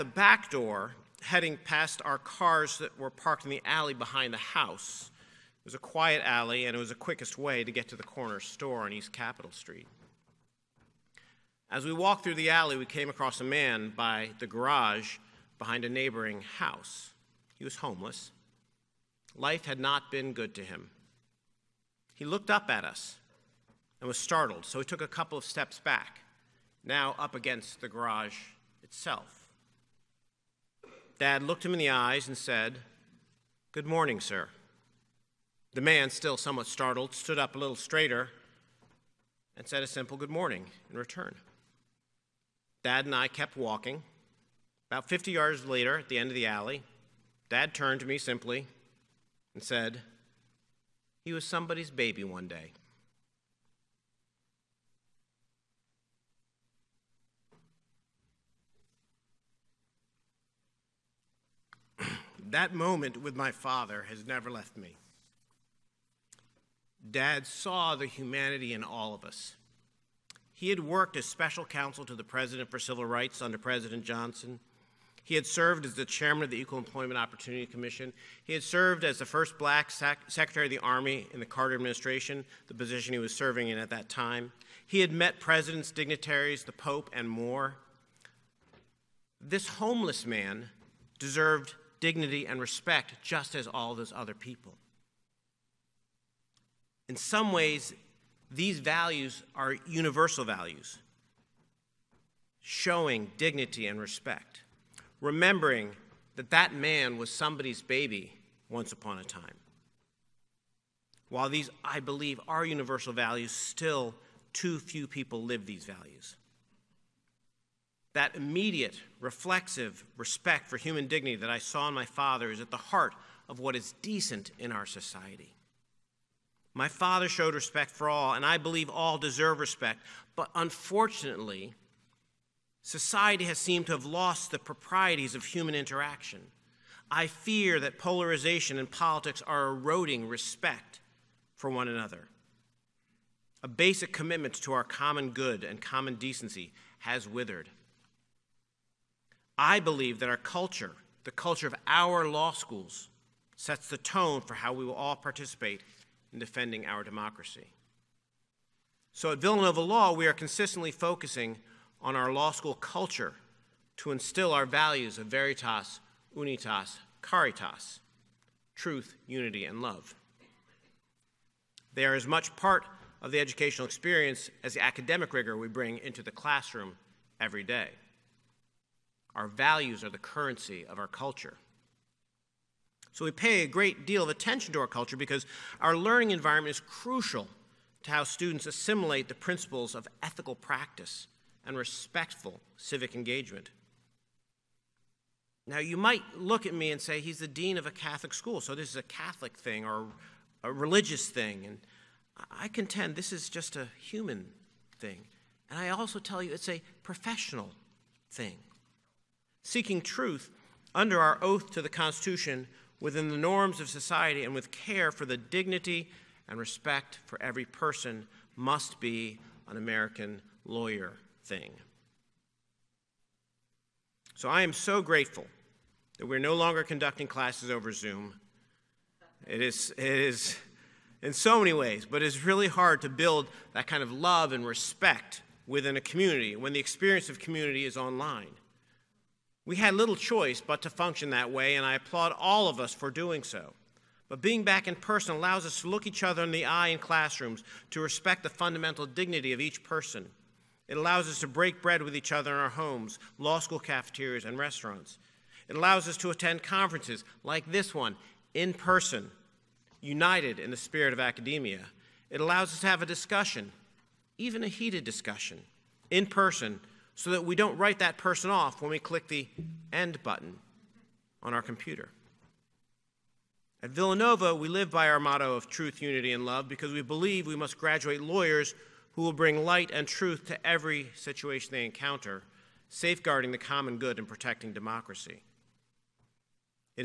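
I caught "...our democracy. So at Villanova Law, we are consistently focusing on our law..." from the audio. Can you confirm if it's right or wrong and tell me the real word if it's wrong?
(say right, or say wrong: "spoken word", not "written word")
right.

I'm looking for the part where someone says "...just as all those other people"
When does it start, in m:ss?
1:33.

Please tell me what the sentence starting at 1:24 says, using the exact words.
He had met presidents, dignitaries, the Pope, and more.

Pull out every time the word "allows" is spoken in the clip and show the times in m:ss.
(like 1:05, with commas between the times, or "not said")
4:05, 4:10, 4:15, 4:22.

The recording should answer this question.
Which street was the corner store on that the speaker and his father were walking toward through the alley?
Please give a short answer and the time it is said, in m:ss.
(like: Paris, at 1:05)
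East Capitol Street, at 0:08.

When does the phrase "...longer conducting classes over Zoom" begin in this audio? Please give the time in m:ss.
3:46.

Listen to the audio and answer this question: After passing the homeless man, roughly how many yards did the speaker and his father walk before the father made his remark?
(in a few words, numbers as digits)
50.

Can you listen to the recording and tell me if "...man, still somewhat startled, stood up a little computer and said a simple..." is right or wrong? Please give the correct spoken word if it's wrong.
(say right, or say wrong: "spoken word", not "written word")
wrong: "straighter", not "computer".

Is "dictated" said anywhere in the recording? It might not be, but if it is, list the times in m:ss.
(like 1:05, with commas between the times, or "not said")
not said.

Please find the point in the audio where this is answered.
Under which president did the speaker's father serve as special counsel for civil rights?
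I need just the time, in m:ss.
1:13.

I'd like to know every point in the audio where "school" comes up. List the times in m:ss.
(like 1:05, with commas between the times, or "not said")
2:32, 2:42, 3:18, 4:13.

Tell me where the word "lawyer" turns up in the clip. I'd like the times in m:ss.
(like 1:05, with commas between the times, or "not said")
3:40, 4:38.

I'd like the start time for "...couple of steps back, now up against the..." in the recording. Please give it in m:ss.
0:25.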